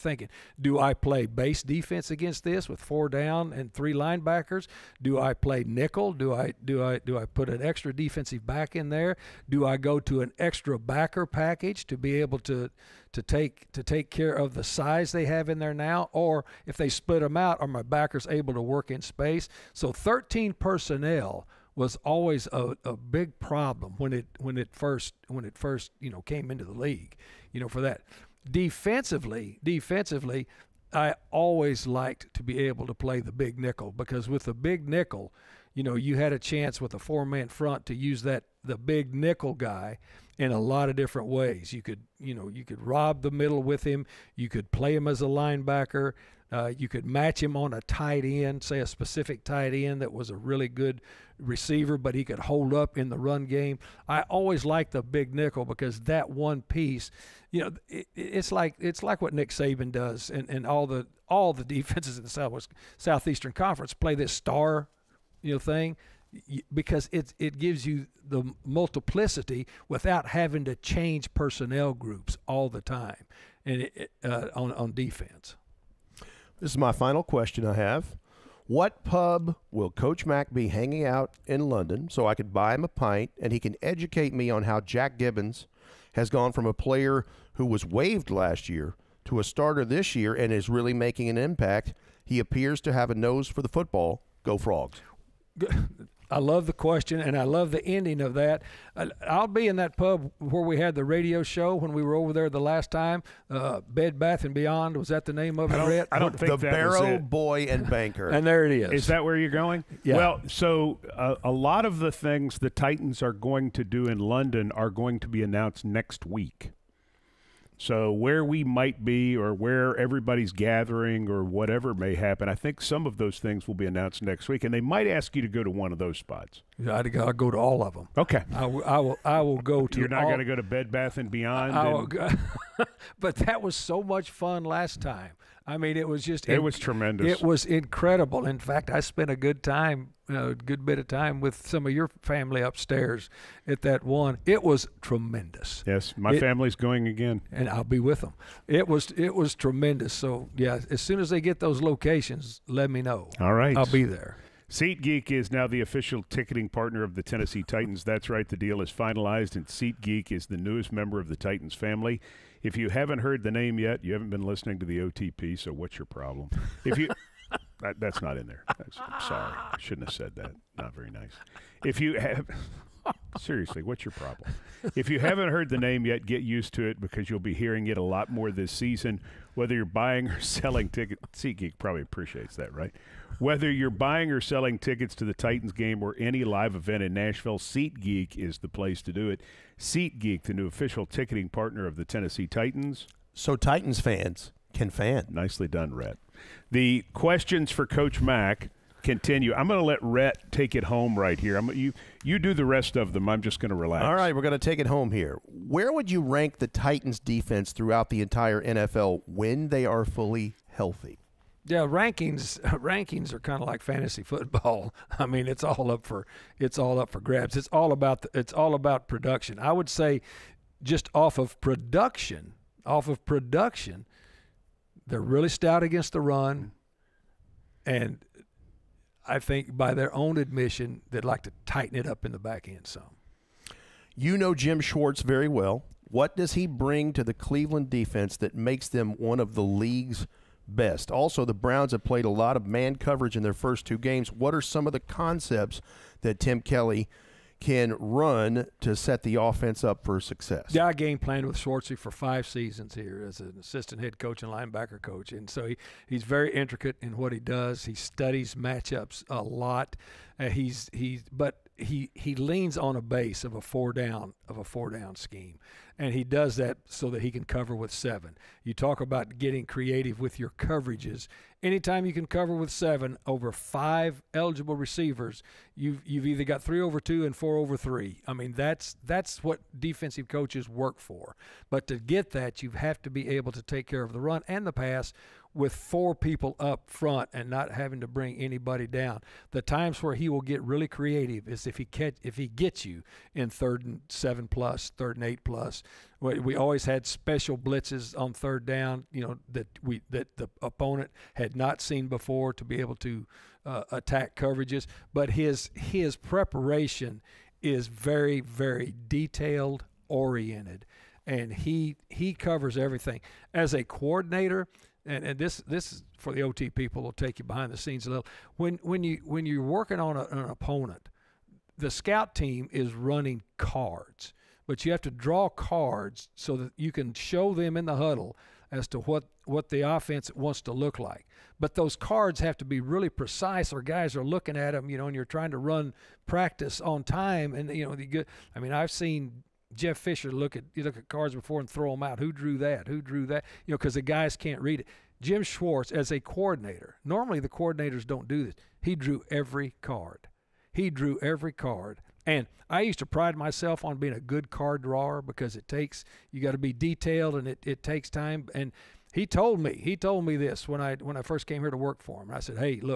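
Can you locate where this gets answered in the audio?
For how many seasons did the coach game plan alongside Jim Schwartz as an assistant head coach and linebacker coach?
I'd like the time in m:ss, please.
4:12.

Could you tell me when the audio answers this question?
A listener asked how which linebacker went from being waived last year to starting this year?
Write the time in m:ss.
1:24.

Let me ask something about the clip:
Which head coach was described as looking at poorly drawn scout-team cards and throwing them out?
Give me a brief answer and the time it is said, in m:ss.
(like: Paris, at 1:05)
Jeff Fisher, at 5:39.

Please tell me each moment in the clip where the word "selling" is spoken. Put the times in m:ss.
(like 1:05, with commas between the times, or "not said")
3:00, 3:04.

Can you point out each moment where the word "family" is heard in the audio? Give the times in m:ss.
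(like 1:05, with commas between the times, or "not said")
2:22, 2:26, 2:41.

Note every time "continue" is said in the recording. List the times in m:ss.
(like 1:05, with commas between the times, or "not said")
3:19.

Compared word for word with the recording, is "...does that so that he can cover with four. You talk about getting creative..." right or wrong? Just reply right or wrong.
wrong.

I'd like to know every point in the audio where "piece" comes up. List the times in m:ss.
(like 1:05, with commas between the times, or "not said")
0:56.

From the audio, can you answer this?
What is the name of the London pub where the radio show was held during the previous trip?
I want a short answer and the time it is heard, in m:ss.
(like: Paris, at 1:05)
The Barrow Boy and Banker, at 1:46.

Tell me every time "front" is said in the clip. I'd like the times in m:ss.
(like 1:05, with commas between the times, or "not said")
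0:37, 4:46.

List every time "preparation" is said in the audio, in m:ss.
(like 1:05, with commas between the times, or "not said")
5:06.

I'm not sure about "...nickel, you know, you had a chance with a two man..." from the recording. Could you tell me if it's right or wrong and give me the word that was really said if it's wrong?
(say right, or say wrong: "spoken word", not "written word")
wrong: "four", not "two".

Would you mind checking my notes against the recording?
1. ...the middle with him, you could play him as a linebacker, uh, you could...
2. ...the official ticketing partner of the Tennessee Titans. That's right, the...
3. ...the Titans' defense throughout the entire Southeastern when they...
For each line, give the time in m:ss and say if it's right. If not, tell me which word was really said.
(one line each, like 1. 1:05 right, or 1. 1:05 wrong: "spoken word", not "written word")
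1. 0:43 right
2. 2:35 right
3. 3:26 wrong: "NFL", not "Southeastern".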